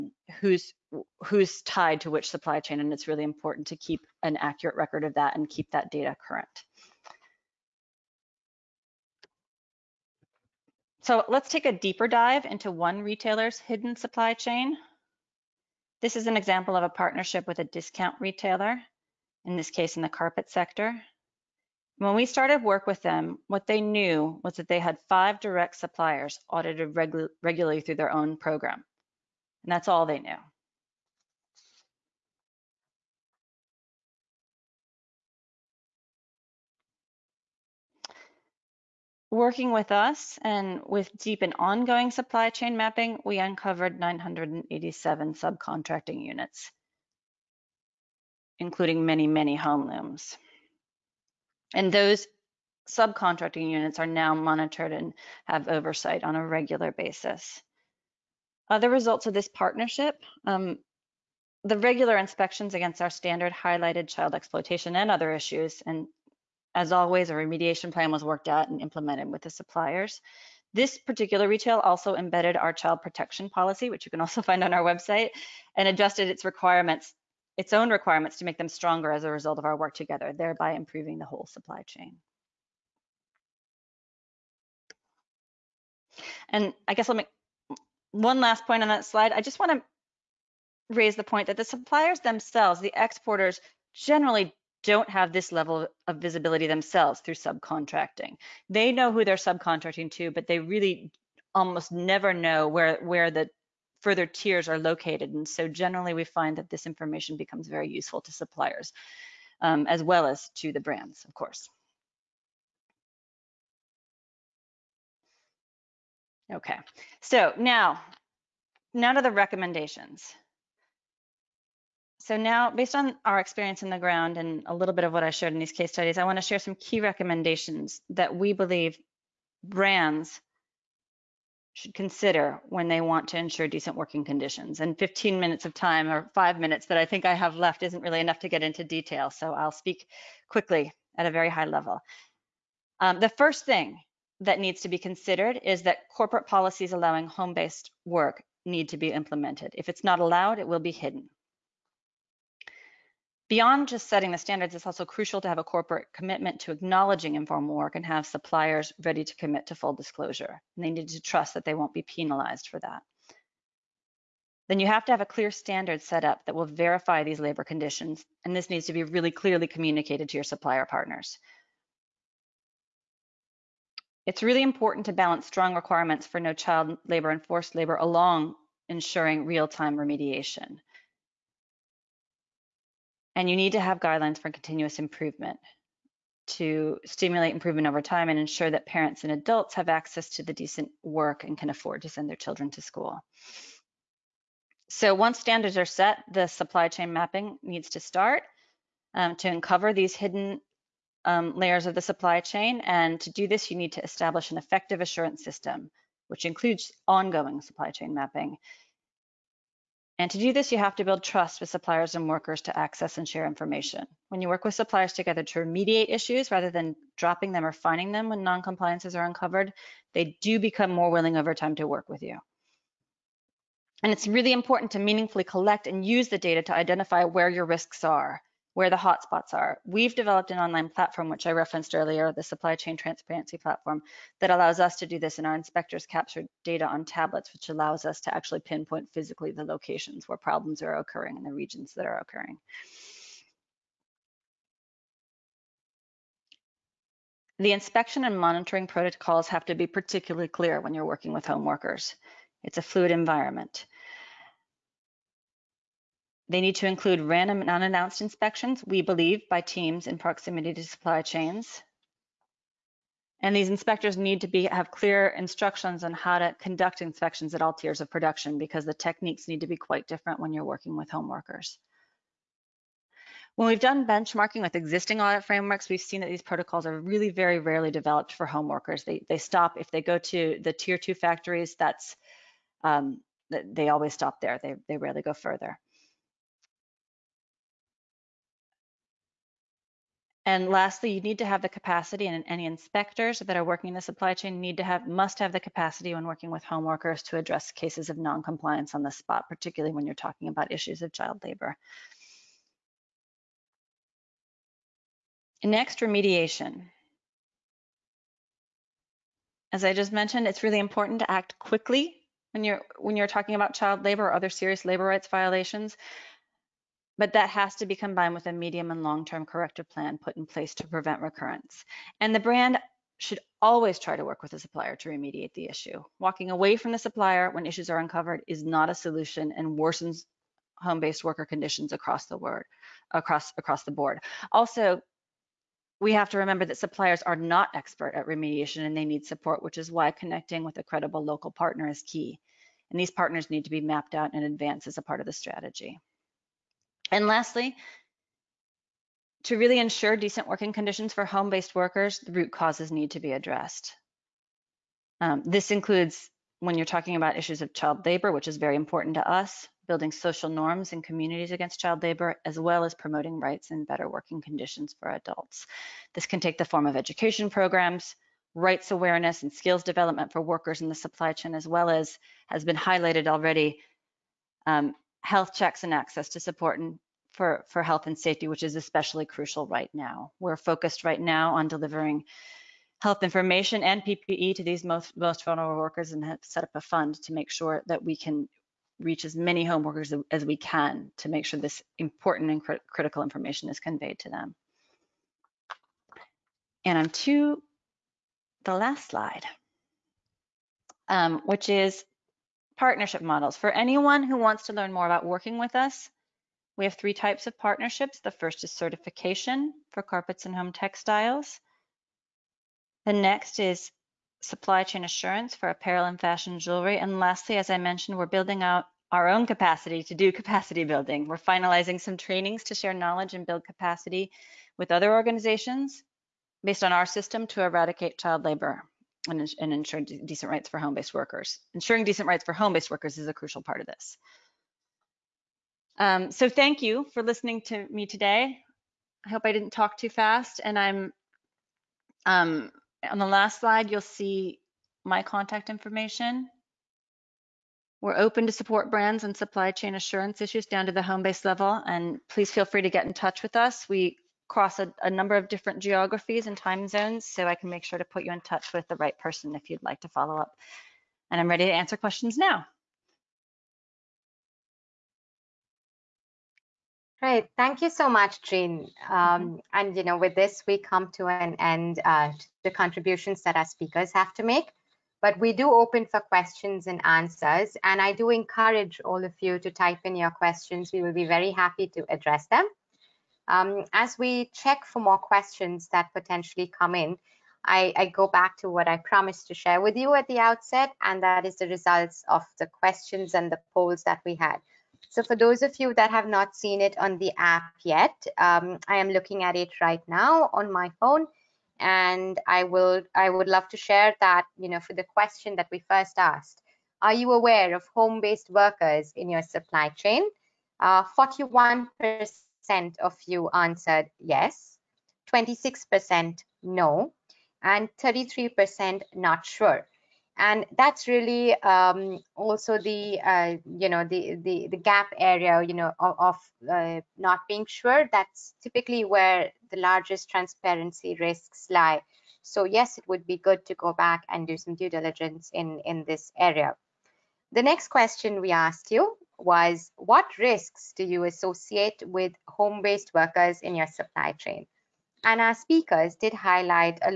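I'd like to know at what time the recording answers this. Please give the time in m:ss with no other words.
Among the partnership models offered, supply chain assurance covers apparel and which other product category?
6:56.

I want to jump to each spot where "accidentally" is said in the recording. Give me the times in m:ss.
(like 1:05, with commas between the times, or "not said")
not said.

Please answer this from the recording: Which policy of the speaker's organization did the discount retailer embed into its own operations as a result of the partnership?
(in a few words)
child protection policy.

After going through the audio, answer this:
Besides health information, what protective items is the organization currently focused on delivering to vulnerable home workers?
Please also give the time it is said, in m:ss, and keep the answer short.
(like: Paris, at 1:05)
PPE, at 6:24.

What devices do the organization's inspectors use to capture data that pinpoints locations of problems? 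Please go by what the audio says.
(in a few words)
tablets.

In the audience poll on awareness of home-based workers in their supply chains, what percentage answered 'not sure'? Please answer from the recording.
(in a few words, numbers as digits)
33%.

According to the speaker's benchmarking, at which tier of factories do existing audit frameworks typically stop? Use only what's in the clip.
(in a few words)
tier two.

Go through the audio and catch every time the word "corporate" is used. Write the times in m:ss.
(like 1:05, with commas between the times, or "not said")
2:26, 2:35.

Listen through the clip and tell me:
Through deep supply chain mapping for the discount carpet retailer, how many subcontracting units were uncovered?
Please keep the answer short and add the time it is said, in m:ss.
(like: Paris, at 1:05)
987, at 0:43.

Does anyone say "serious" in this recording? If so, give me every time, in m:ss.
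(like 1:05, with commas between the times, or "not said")
5:14.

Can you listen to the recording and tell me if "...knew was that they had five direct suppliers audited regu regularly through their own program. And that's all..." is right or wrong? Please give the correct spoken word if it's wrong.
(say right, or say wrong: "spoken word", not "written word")
right.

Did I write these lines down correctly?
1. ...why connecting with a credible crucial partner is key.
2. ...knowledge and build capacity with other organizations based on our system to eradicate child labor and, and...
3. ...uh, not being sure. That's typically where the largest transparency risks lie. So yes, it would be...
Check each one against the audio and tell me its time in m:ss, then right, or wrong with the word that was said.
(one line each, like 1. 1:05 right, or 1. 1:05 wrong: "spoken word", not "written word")
1. 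5:39 wrong: "local", not "crucial"
2. 7:02 right
3. 8:46 right.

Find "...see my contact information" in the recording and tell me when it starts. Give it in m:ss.
7:24.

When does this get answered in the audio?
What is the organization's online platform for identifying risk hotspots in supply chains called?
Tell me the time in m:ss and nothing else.
3:52.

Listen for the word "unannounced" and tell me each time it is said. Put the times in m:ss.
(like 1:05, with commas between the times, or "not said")
4:17.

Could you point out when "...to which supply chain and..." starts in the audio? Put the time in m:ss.
0:02.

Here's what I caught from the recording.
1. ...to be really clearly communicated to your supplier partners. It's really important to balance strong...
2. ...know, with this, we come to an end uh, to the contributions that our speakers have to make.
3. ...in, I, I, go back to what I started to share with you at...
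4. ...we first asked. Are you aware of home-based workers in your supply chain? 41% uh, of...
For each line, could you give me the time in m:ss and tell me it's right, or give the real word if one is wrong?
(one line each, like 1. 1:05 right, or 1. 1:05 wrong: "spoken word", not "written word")
1. 2:48 right
2. 7:50 right
3. 8:06 wrong: "promised", not "started"
4. 8:25 right.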